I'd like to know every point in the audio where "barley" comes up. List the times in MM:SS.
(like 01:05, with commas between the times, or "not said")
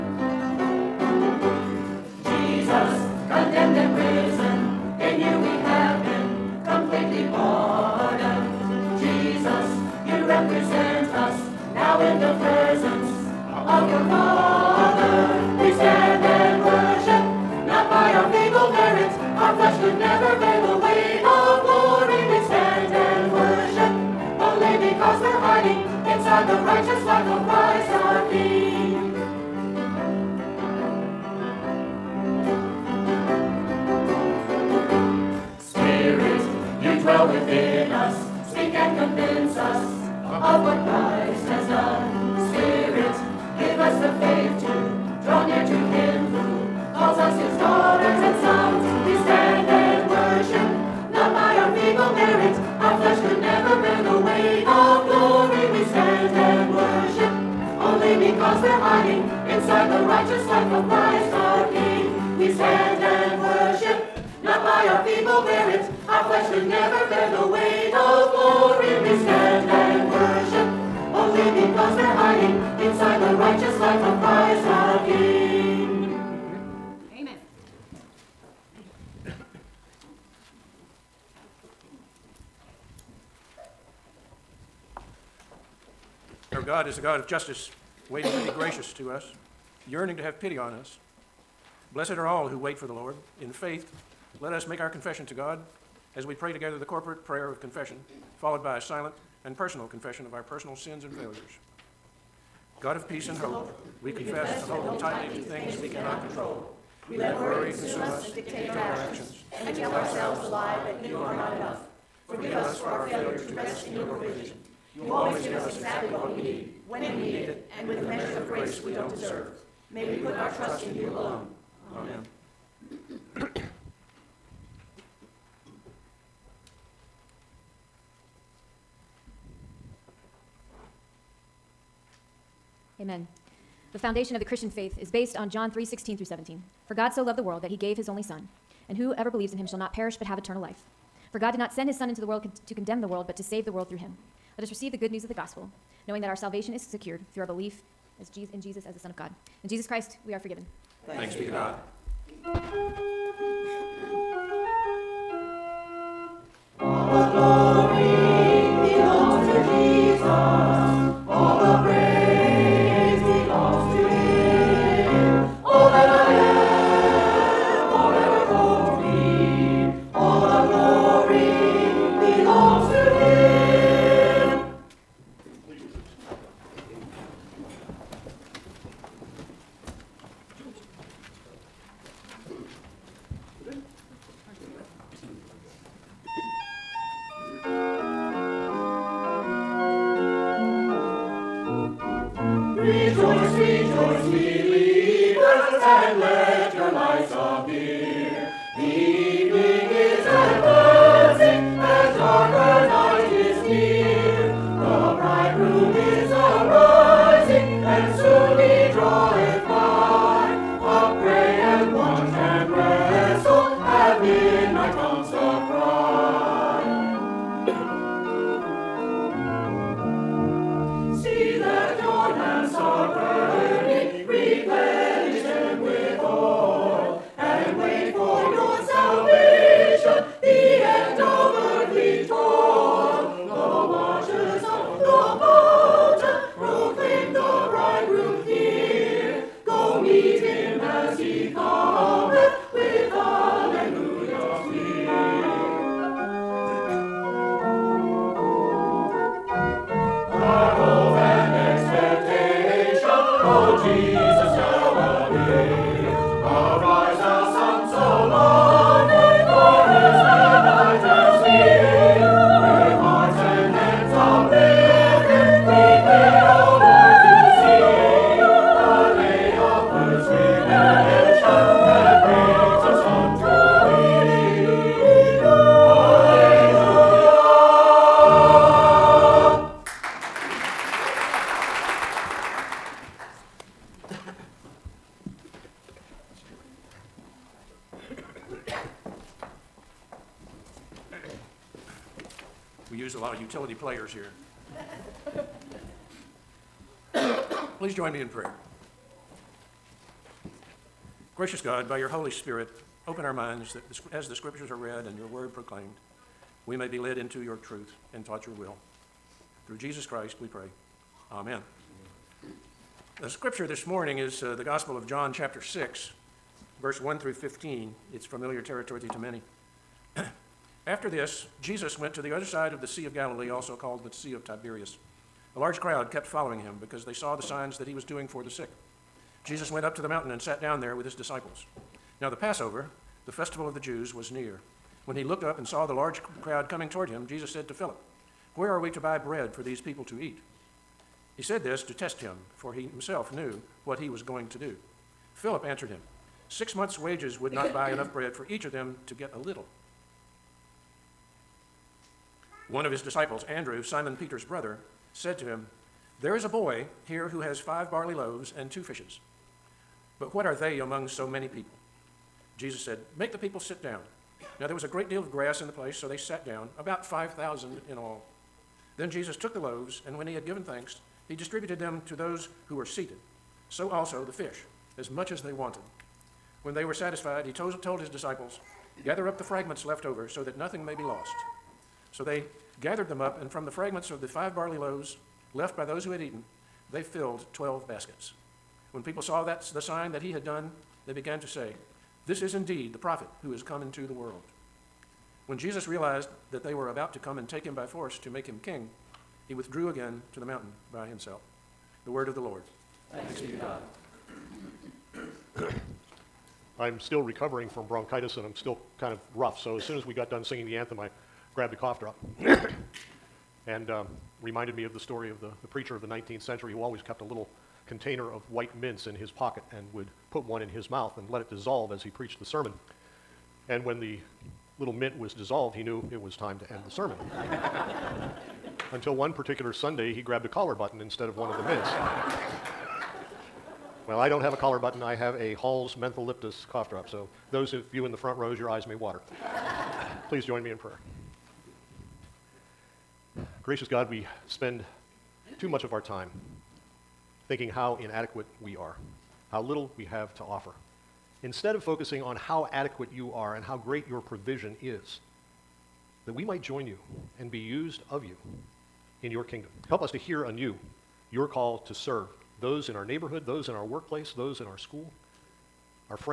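05:57, 06:24.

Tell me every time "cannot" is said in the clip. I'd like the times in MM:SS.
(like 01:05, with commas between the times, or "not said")
01:45.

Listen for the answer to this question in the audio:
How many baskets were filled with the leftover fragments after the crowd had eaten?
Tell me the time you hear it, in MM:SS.
06:27.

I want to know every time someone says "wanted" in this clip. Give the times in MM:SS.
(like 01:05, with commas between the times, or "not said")
06:15.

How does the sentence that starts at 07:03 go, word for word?
And when the little mint was dissolved, he knew it was time to end the sermon.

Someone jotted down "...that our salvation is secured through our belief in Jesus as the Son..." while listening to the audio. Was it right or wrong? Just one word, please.
right.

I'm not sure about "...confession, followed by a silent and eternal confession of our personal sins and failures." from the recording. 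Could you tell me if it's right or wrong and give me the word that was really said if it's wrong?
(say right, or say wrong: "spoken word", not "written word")
wrong: "personal", not "eternal".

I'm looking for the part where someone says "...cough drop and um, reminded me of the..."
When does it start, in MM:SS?
06:51.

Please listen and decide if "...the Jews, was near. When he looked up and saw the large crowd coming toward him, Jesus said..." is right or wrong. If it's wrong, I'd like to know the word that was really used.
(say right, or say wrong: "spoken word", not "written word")
right.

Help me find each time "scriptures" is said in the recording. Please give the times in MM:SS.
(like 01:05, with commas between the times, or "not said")
05:04, 05:13.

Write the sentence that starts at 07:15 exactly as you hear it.
I have a Hall's Mentholyptus cough drop.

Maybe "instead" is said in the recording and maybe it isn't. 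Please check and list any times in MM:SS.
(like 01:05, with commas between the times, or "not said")
07:11, 07:31.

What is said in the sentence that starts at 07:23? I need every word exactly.
Gracious God, we spend too much of our time thinking how inadequate we are, how little we have to offer.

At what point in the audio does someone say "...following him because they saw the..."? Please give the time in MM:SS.
05:26.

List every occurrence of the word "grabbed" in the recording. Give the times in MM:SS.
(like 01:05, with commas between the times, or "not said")
06:51, 07:10.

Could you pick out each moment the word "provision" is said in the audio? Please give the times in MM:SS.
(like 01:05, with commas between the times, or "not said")
01:54, 07:34.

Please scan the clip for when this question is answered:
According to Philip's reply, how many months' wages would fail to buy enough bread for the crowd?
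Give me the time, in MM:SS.
05:46.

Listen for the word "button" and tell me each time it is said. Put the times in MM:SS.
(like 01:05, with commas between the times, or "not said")
07:10, 07:14.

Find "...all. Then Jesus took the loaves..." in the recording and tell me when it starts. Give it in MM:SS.
06:07.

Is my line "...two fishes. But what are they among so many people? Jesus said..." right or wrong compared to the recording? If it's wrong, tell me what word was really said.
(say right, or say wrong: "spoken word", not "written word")
right.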